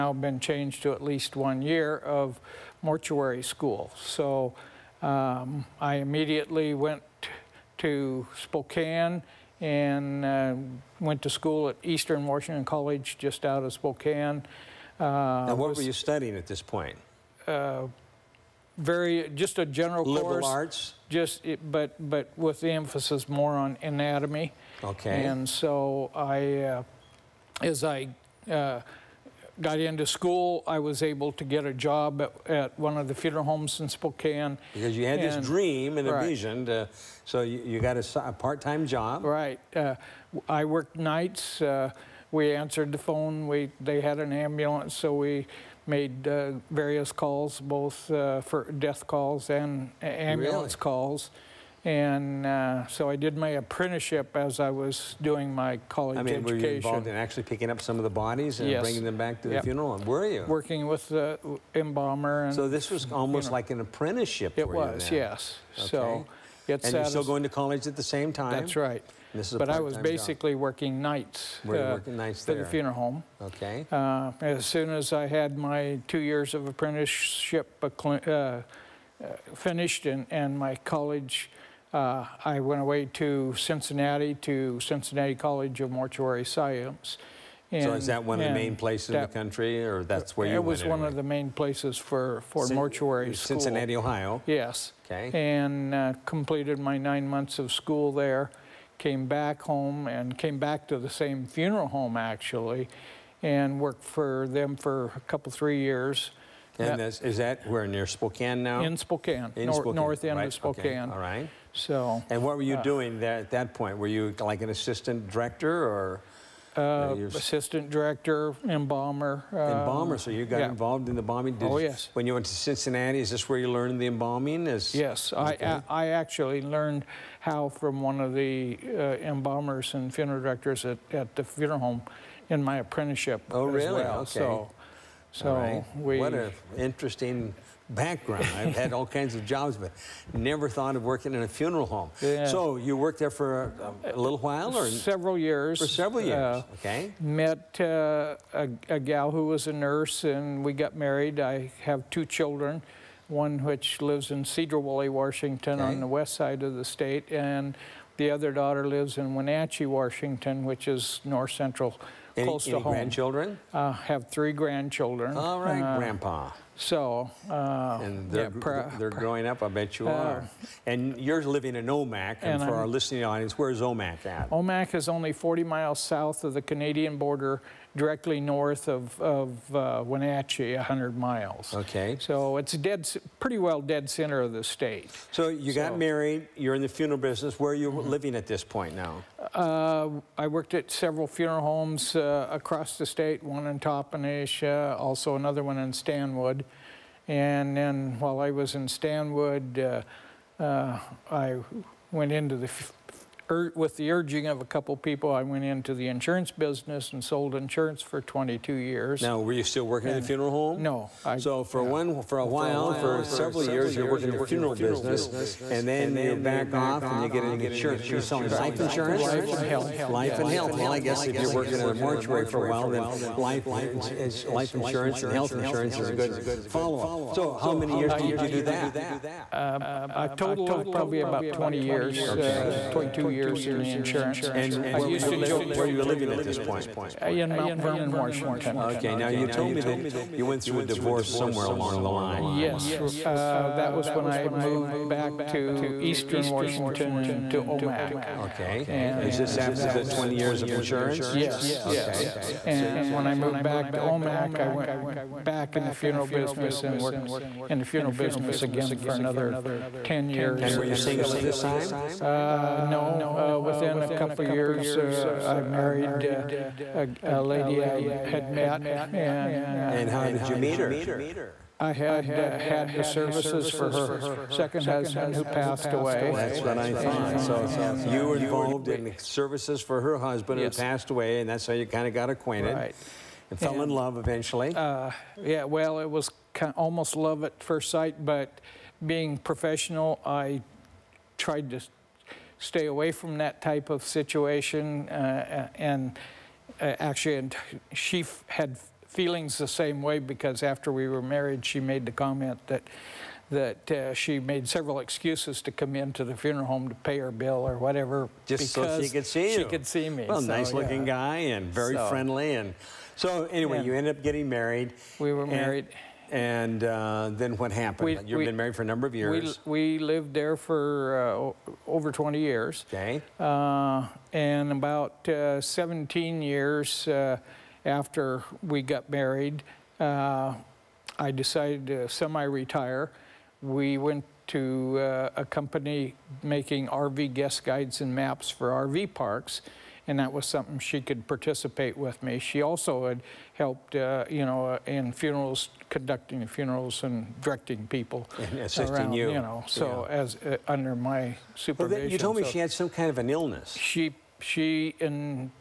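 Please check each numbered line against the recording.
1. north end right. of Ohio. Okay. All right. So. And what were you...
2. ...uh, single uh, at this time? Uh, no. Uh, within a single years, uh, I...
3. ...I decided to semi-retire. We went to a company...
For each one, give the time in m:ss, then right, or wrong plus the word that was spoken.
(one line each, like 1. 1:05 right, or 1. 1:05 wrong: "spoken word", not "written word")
1. 1:49 wrong: "Spokane", not "Ohio"
2. 4:20 wrong: "couple", not "single"
3. 5:31 right.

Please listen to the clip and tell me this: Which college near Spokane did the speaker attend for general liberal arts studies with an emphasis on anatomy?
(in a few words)
Eastern Washington College.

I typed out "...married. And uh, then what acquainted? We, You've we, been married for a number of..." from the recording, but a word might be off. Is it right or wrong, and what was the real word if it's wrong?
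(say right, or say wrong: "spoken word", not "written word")
wrong: "happened", not "acquainted".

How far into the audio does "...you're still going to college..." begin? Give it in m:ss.
1:06.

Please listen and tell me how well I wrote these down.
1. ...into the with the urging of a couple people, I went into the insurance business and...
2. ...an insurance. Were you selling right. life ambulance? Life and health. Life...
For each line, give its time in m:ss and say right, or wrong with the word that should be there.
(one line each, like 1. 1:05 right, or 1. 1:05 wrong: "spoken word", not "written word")
1. 3:22 right
2. 3:37 wrong: "insurance", not "ambulance".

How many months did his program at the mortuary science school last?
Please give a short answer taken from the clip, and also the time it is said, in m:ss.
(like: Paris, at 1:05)
9, at 1:36.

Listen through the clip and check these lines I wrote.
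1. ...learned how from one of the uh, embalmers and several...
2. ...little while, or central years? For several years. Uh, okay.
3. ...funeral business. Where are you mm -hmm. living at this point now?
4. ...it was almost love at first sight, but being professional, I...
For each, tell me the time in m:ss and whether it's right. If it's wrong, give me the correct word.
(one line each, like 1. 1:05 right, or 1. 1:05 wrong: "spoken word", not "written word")
1. 2:06 wrong: "funeral", not "several"
2. 2:24 wrong: "several", not "central"
3. 3:06 right
4. 4:45 right.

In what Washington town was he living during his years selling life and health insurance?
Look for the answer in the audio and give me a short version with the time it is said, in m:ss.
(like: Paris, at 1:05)
Mount Vernon, at 3:57.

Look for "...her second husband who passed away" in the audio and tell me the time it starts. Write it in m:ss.
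4:33.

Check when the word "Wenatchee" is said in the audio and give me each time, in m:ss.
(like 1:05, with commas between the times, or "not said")
2:39, 3:00.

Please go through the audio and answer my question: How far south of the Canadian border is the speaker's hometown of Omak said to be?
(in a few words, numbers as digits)
40 miles.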